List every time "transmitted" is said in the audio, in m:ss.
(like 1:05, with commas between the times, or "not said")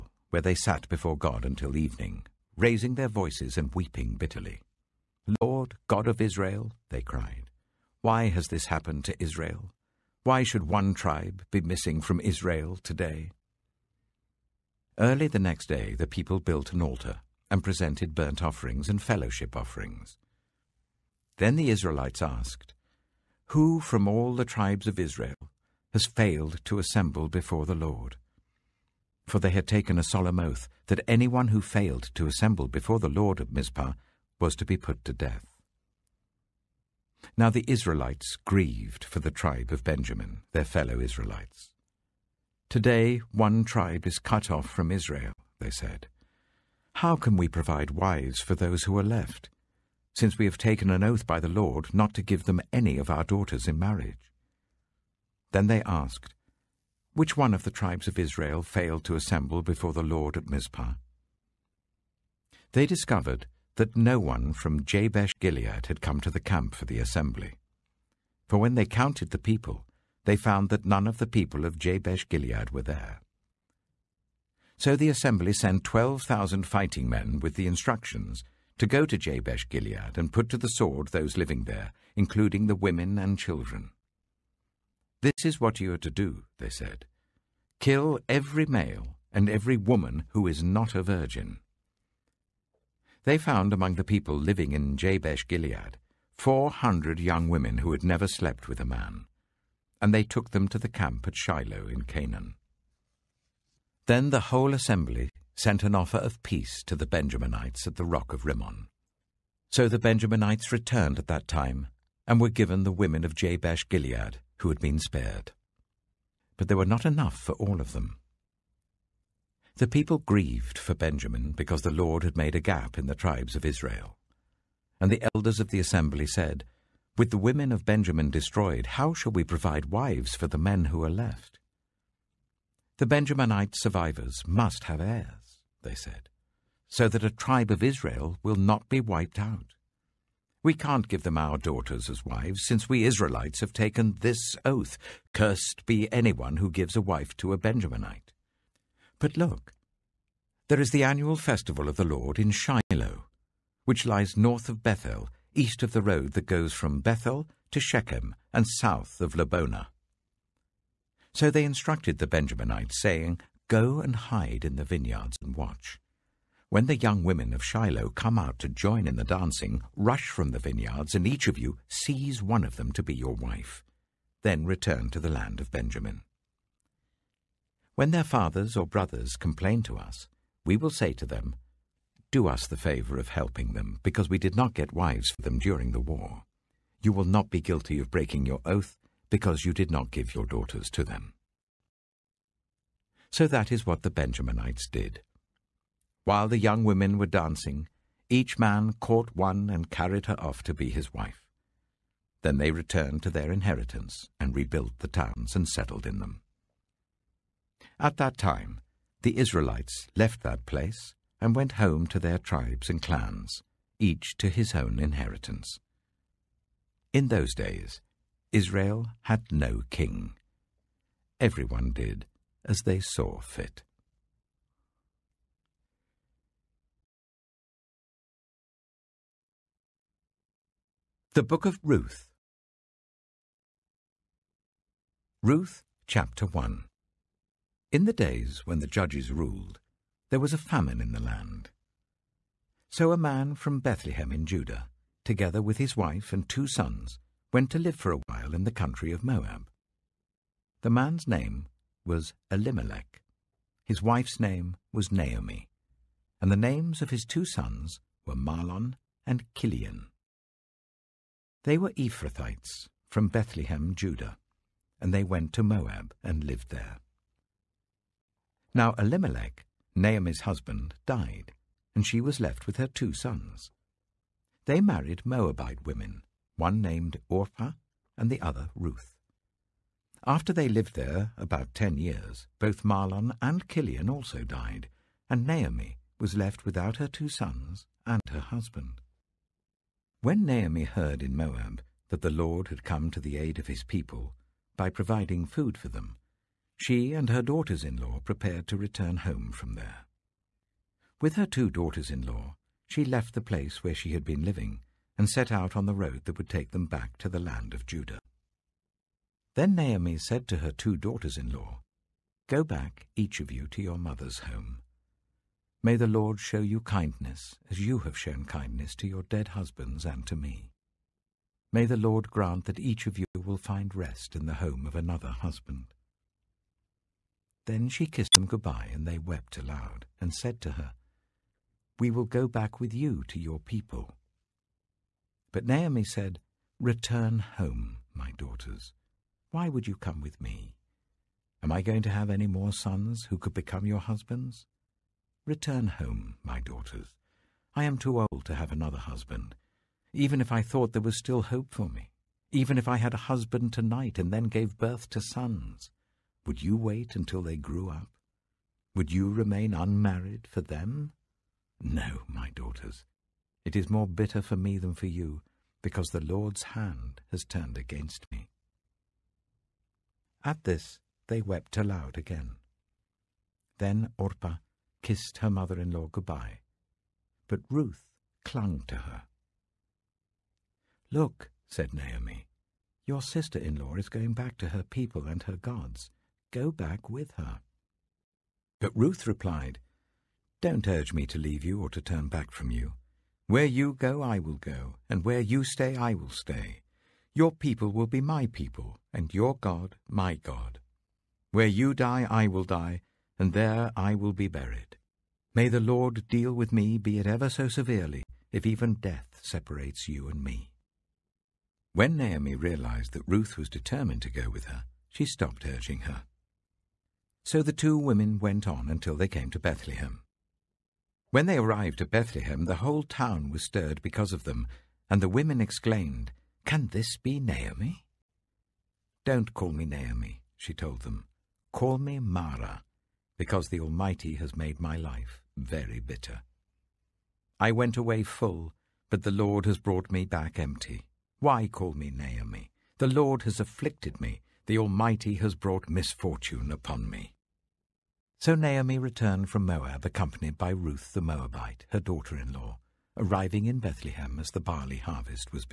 not said.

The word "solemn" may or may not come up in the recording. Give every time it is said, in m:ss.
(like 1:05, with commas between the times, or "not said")
0:30.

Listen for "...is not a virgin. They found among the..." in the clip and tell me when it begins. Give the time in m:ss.
1:30.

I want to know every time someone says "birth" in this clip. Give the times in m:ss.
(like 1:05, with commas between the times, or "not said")
5:54.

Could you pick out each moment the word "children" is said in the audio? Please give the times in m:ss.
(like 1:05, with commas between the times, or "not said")
1:23.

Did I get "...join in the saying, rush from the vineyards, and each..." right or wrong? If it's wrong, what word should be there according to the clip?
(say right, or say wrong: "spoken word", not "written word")
wrong: "dancing", not "saying".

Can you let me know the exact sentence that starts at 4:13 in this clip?
His wife's name was Naomi, and the names of his two sons were Mahlon and Kilion.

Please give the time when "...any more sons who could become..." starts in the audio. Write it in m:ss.
5:42.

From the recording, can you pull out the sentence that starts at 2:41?
So they instructed the Benjaminites, saying, Go and hide in the vineyards and watch.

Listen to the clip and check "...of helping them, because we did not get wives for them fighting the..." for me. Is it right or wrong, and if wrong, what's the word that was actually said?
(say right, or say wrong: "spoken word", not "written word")
wrong: "during", not "fighting".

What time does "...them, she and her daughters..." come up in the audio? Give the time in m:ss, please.
4:55.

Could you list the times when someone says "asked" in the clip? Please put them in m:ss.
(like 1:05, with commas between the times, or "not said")
0:22, 0:55.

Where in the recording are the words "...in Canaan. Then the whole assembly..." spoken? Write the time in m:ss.
1:41.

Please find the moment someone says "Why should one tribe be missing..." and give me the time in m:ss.
0:10.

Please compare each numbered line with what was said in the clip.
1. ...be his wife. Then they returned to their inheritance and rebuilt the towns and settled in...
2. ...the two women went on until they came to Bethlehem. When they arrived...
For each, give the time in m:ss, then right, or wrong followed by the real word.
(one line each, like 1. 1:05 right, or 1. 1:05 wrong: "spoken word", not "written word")
1. 3:20 right
2. 6:57 right.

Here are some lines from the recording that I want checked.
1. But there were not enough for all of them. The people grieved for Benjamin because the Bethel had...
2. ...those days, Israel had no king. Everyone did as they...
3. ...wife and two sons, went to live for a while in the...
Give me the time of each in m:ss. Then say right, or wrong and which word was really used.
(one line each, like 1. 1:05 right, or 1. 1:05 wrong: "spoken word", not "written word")
1. 1:56 wrong: "Lord", not "Bethel"
2. 3:37 right
3. 4:05 right.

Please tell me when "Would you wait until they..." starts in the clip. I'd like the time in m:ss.
5:56.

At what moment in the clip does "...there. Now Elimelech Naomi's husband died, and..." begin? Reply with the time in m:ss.
4:26.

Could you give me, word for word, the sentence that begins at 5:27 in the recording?
Then she kissed them goodbye, and they wept aloud, and said to her, We will go back with you to your people.